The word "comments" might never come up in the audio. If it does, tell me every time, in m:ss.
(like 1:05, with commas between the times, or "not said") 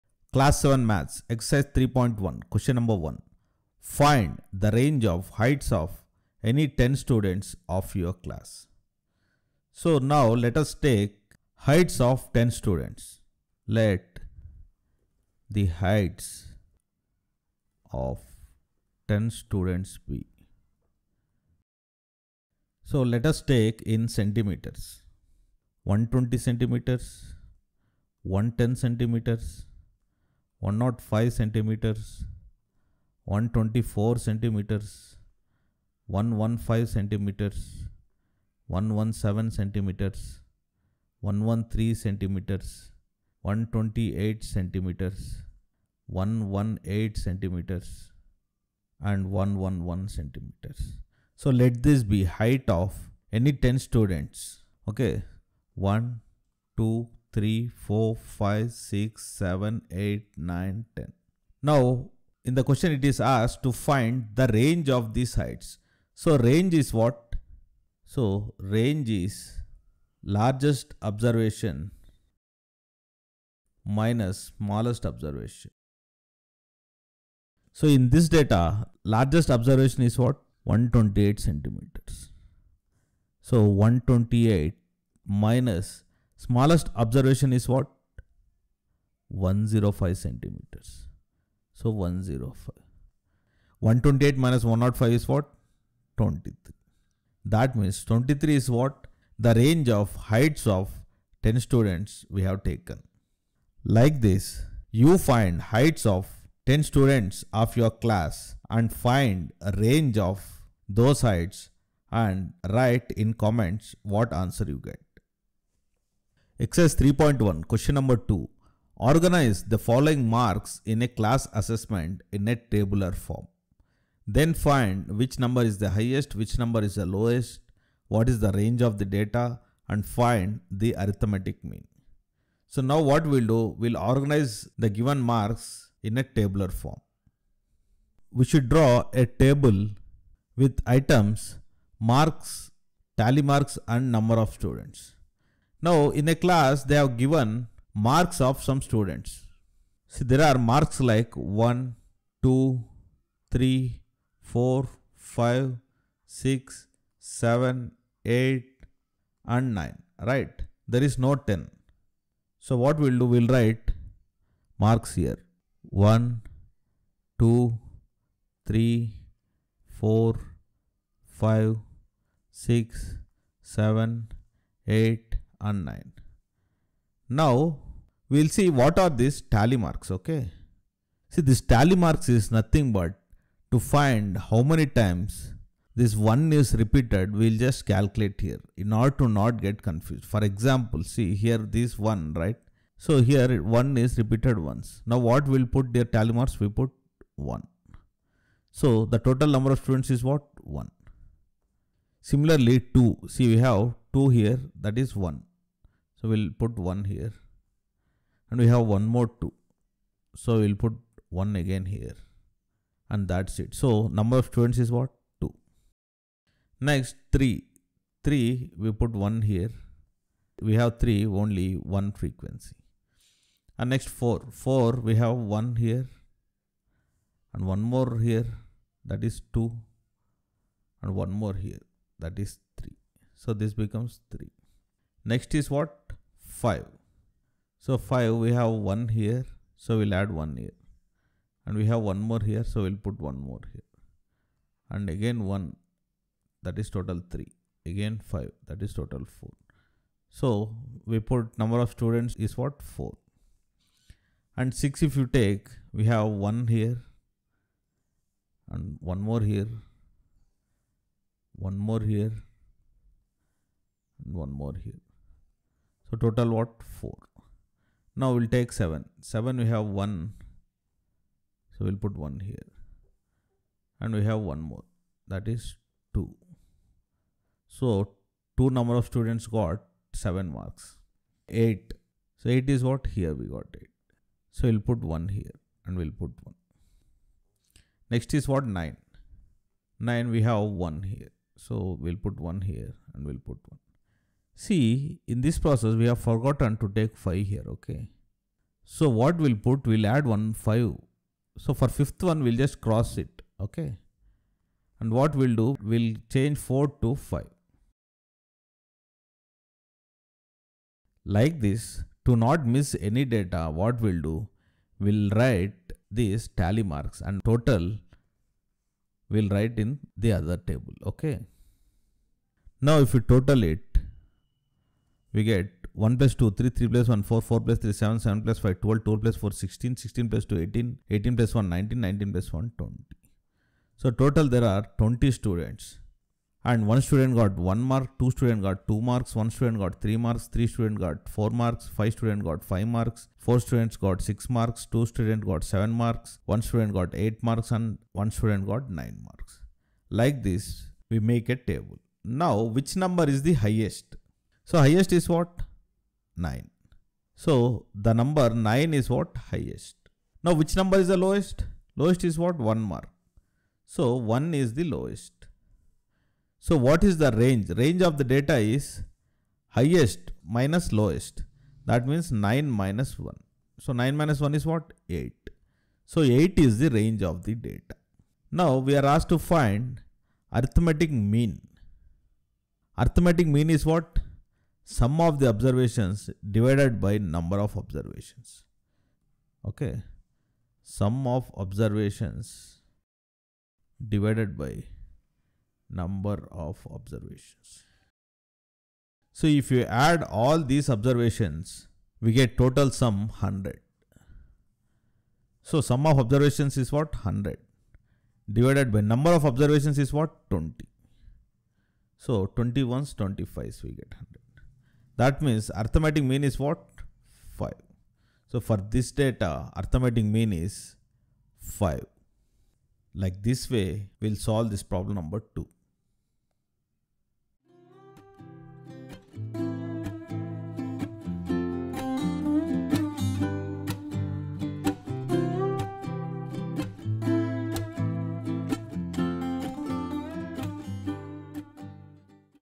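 1:53.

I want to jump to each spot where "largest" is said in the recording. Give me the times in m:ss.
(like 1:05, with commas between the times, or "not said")
1:10, 1:19.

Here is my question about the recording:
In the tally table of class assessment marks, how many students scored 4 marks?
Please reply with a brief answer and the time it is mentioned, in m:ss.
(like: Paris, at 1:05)
3, at 5:40.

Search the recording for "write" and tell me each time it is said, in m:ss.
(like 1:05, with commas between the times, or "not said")
1:52, 2:43, 5:15, 5:19.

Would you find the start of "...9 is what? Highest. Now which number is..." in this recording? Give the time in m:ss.
5:58.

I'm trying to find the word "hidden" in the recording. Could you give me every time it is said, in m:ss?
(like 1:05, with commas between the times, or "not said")
not said.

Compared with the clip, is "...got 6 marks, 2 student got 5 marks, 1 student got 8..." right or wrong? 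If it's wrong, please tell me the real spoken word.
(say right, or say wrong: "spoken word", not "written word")
wrong: "7", not "5".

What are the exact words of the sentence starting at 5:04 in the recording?
And what we'll do, we'll change 4 to 5.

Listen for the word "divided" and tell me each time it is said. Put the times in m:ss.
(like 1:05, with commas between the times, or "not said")
6:26, 6:34, 6:48.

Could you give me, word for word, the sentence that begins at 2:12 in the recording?
So now what we'll do, we'll organize the given marks in a tabular form.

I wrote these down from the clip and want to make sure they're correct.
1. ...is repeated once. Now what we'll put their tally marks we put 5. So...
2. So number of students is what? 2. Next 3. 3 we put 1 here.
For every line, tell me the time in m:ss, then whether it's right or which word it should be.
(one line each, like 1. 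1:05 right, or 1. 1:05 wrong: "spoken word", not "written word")
1. 3:13 wrong: "1", not "5"
2. 3:33 right.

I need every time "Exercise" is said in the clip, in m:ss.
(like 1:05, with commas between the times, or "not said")
0:01, 1:56.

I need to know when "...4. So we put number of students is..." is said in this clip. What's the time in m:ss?
4:09.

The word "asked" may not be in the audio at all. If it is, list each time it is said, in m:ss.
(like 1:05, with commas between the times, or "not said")
1:03, 6:19.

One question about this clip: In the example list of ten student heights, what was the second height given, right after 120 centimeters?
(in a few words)
110 centimeters.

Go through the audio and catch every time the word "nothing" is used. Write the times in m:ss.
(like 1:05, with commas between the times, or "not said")
3:02.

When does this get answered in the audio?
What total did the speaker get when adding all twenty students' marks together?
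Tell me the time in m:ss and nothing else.
6:42.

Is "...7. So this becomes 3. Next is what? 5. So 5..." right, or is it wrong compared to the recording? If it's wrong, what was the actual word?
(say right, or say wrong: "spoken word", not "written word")
wrong: "3", not "7".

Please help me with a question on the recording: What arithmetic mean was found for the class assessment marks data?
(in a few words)
5.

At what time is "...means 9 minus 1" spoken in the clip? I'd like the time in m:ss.
6:12.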